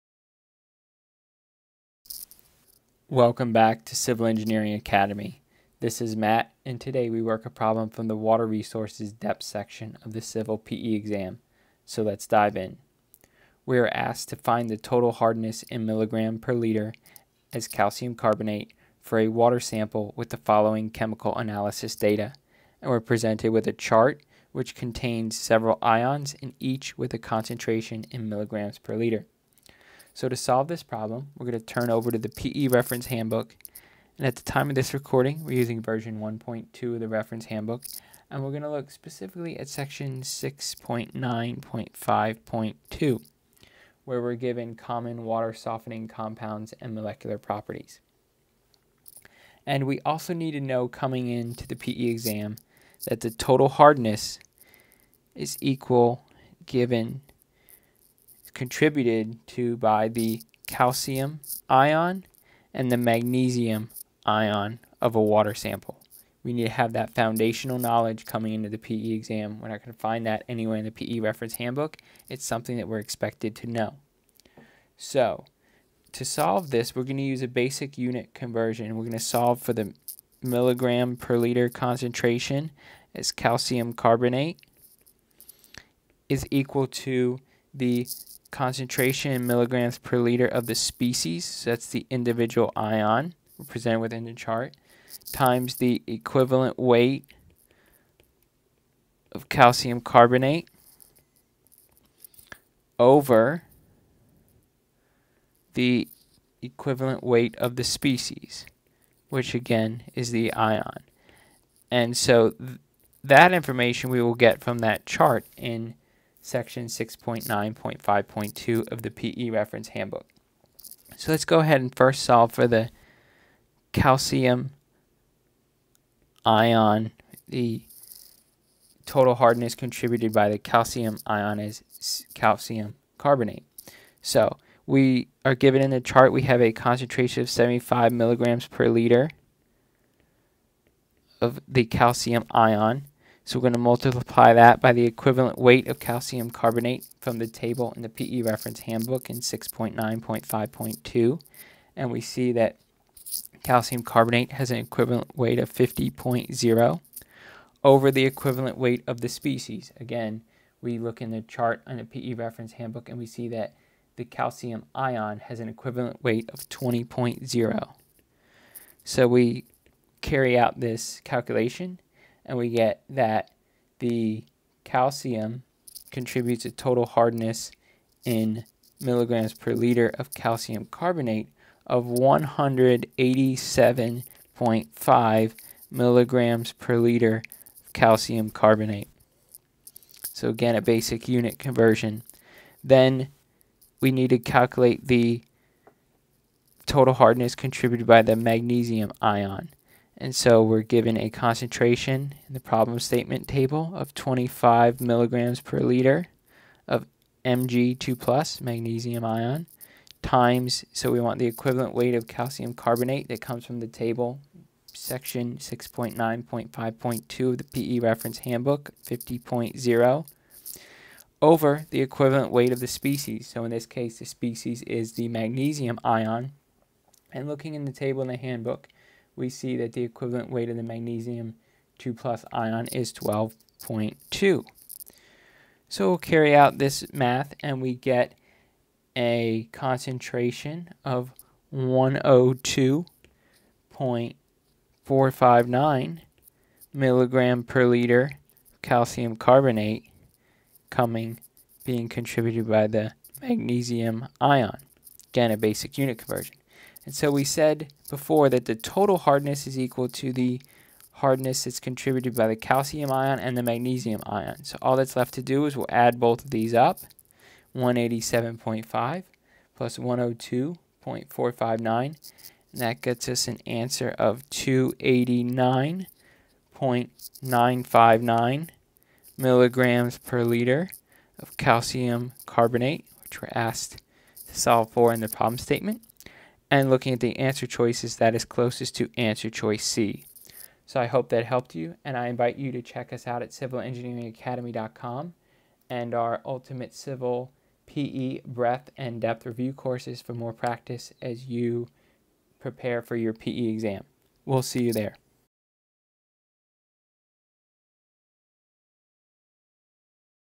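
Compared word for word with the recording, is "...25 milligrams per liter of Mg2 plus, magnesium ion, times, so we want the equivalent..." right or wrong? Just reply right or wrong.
right.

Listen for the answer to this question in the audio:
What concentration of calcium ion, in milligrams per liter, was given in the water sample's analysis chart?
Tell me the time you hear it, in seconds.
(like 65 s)
137 s.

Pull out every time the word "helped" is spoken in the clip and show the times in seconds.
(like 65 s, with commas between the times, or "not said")
291 s.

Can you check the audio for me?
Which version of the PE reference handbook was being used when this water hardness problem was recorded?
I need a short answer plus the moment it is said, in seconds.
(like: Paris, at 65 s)
1.2, at 35 s.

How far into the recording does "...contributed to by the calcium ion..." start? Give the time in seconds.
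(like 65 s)
58 s.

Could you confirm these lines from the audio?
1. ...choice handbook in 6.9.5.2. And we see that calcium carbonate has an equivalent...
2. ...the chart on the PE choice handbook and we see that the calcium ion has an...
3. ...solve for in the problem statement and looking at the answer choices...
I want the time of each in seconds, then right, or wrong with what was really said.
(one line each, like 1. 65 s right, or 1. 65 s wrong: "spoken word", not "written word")
1. 148 s wrong: "reference", not "choice"
2. 161 s wrong: "reference", not "choice"
3. 284 s right.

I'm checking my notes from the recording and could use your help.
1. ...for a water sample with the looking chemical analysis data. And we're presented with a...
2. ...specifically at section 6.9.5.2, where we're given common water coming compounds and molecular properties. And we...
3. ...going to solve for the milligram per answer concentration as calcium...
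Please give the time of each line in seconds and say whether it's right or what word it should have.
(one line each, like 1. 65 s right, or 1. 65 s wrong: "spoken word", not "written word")
1. 19 s wrong: "following", not "looking"
2. 38 s wrong: "softening", not "coming"
3. 79 s wrong: "liter", not "answer".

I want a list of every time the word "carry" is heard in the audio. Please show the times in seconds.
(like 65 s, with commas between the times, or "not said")
170 s, 236 s.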